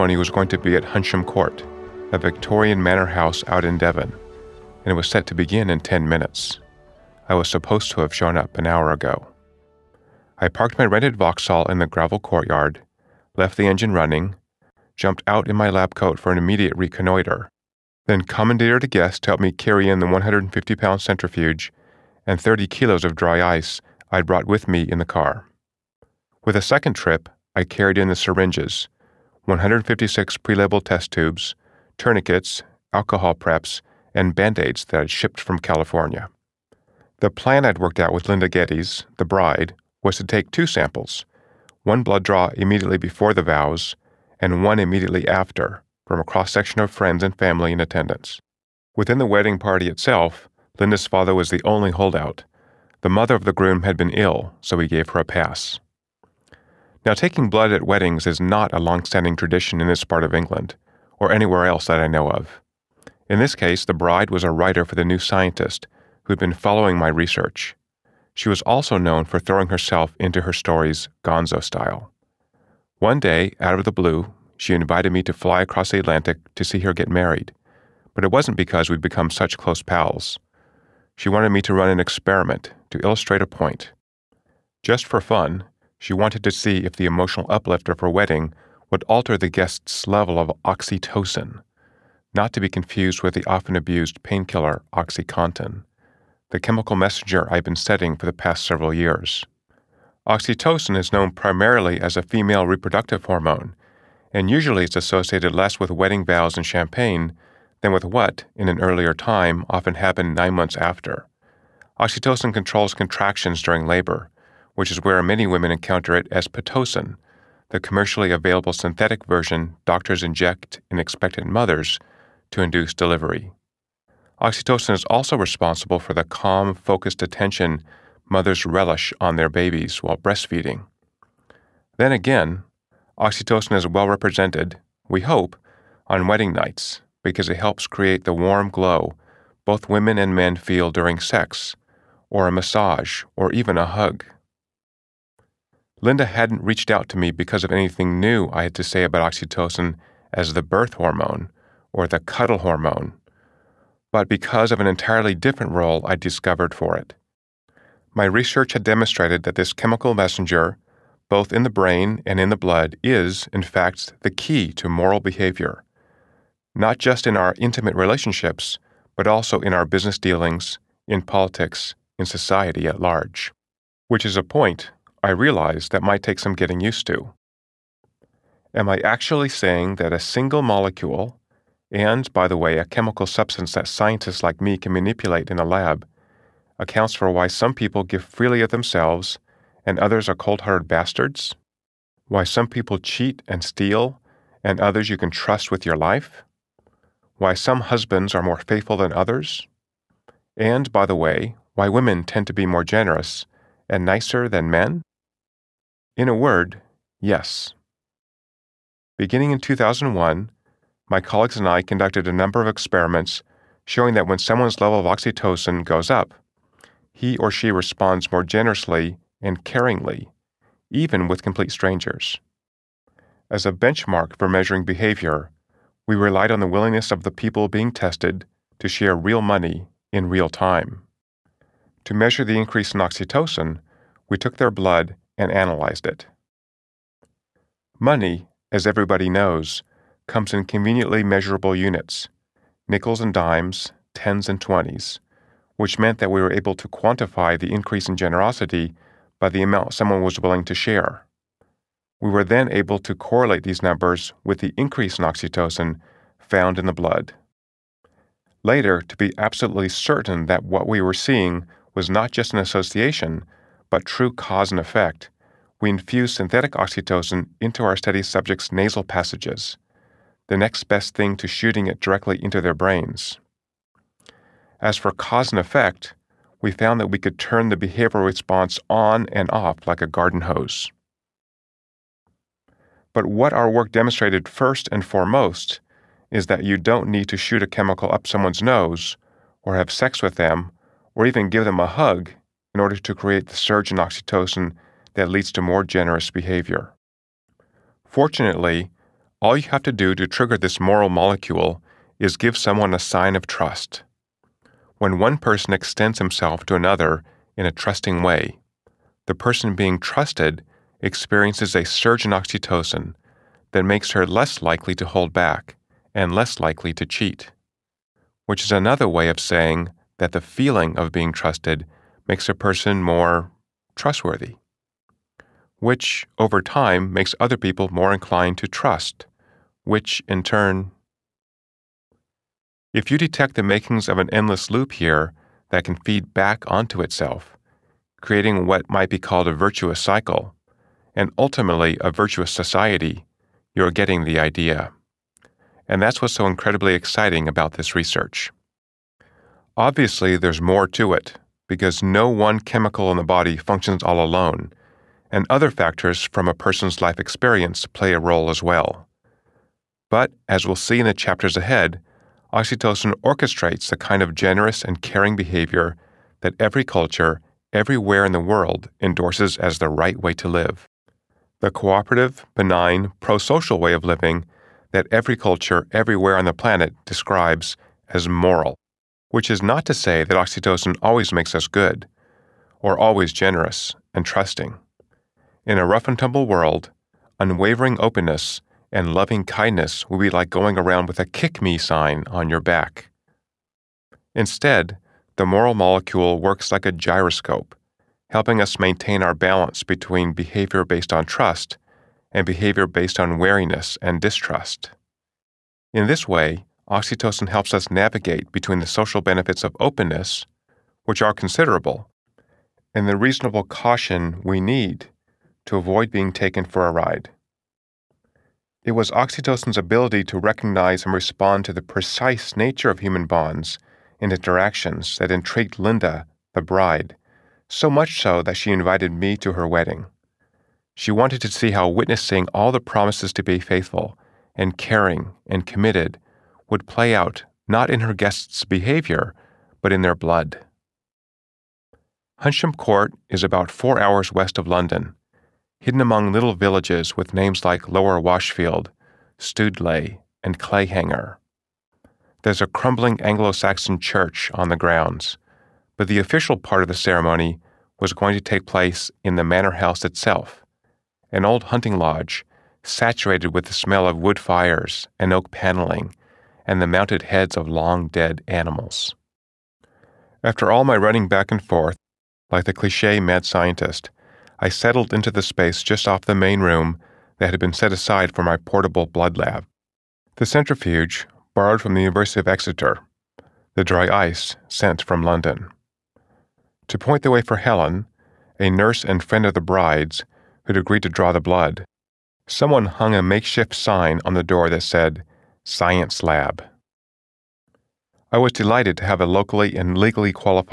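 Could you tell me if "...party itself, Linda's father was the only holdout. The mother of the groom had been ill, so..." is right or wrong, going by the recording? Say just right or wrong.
right.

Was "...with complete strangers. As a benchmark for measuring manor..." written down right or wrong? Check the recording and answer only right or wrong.
wrong.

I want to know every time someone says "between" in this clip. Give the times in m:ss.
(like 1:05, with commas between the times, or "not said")
6:39, 6:48.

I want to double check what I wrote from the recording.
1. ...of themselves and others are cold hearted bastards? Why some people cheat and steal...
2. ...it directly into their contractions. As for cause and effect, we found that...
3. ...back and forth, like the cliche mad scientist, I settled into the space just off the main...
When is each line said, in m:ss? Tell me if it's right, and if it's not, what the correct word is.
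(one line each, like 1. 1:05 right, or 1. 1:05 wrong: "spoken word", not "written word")
1. 3:08 right
2. 4:31 wrong: "brains", not "contractions"
3. 7:51 right.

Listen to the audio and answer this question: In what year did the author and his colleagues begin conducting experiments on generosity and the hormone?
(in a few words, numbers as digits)
2001.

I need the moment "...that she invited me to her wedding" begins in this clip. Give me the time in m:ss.
7:08.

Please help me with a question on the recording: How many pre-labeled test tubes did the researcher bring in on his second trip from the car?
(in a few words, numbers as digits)
156.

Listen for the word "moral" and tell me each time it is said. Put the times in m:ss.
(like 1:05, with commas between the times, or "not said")
2:44, 5:00, 6:18, 6:35.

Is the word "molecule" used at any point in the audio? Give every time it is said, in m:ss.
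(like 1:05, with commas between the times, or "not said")
3:00, 5:01, 6:35.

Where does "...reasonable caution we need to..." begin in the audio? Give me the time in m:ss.
6:53.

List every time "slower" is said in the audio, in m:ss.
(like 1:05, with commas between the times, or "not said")
not said.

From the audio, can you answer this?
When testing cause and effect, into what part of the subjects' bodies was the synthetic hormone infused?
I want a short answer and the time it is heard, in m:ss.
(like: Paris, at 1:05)
nasal passages, at 4:28.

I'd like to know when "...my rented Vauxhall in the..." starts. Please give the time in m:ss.
0:10.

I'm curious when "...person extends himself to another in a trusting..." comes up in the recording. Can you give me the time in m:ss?
5:05.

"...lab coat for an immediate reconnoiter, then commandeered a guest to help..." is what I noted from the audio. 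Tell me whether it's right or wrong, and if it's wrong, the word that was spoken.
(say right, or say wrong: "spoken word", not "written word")
right.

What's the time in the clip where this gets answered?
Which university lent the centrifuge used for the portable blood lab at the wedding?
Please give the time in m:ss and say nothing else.
8:02.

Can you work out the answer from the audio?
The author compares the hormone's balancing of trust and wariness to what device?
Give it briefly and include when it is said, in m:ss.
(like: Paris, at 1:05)
a gyroscope, at 6:36.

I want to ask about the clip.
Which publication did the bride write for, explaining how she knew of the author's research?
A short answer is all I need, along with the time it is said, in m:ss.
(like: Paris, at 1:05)
The New Scientist, at 1:04.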